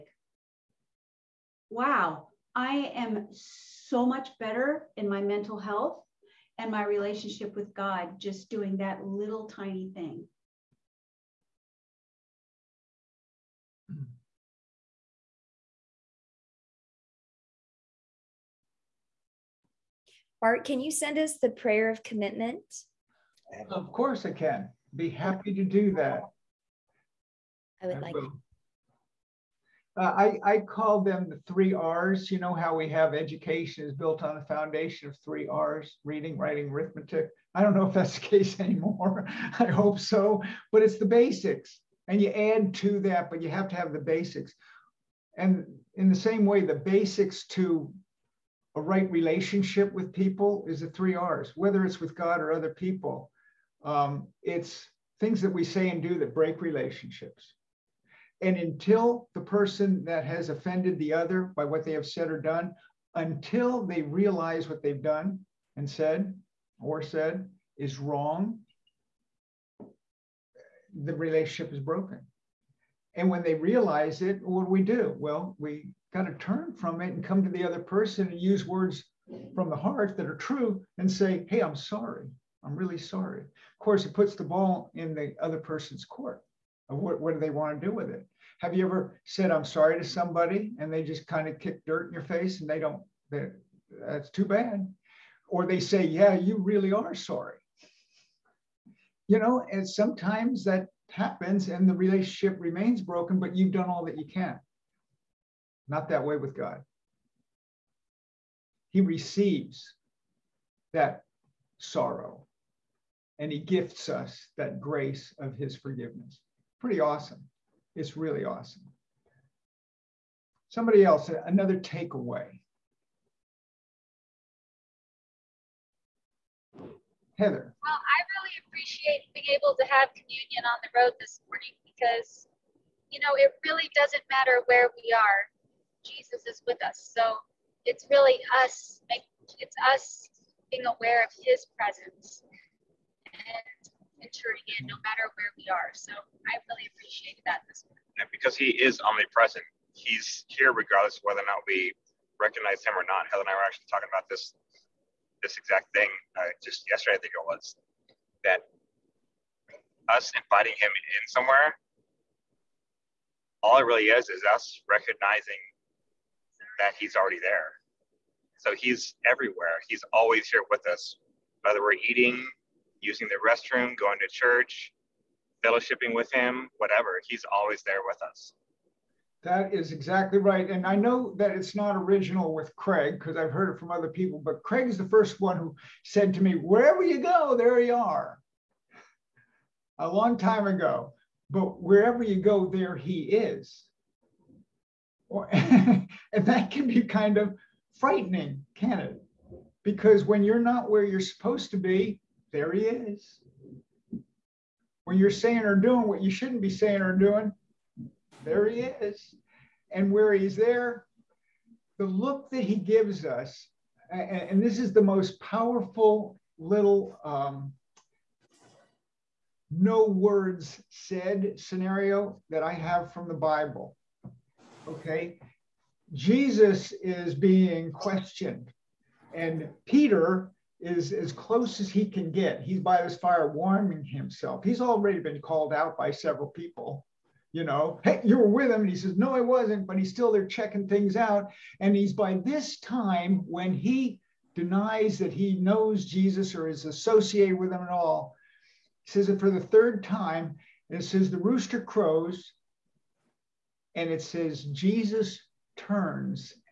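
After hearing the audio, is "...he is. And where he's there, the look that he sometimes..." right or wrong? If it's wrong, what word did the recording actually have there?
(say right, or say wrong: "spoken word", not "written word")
wrong: "gives", not "sometimes".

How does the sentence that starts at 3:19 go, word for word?
Because when you're not where you're supposed to be, there he is.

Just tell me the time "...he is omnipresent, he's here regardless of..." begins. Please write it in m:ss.
2:28.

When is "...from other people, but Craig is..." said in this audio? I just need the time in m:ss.
3:03.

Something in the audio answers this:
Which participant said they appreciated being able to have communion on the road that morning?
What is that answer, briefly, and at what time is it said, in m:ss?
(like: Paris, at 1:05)
Heather, at 2:07.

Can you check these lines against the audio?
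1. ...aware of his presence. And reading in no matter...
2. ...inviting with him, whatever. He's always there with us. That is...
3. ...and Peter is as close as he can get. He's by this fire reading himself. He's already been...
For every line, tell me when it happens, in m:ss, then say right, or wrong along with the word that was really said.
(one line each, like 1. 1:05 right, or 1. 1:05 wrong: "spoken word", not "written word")
1. 2:20 wrong: "entering", not "reading"
2. 2:55 wrong: "fellowshipping", not "inviting"
3. 3:49 wrong: "warming", not "reading".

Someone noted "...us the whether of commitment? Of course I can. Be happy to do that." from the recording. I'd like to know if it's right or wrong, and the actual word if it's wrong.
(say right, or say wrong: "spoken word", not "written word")
wrong: "prayer", not "whether".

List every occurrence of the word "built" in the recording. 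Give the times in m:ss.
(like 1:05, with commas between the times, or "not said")
0:33.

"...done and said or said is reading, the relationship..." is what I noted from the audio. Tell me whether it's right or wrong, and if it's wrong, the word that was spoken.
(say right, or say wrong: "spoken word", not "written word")
wrong: "wrong", not "reading".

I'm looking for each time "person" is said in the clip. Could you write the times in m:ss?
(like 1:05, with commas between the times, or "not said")
0:59, 1:17, 1:25.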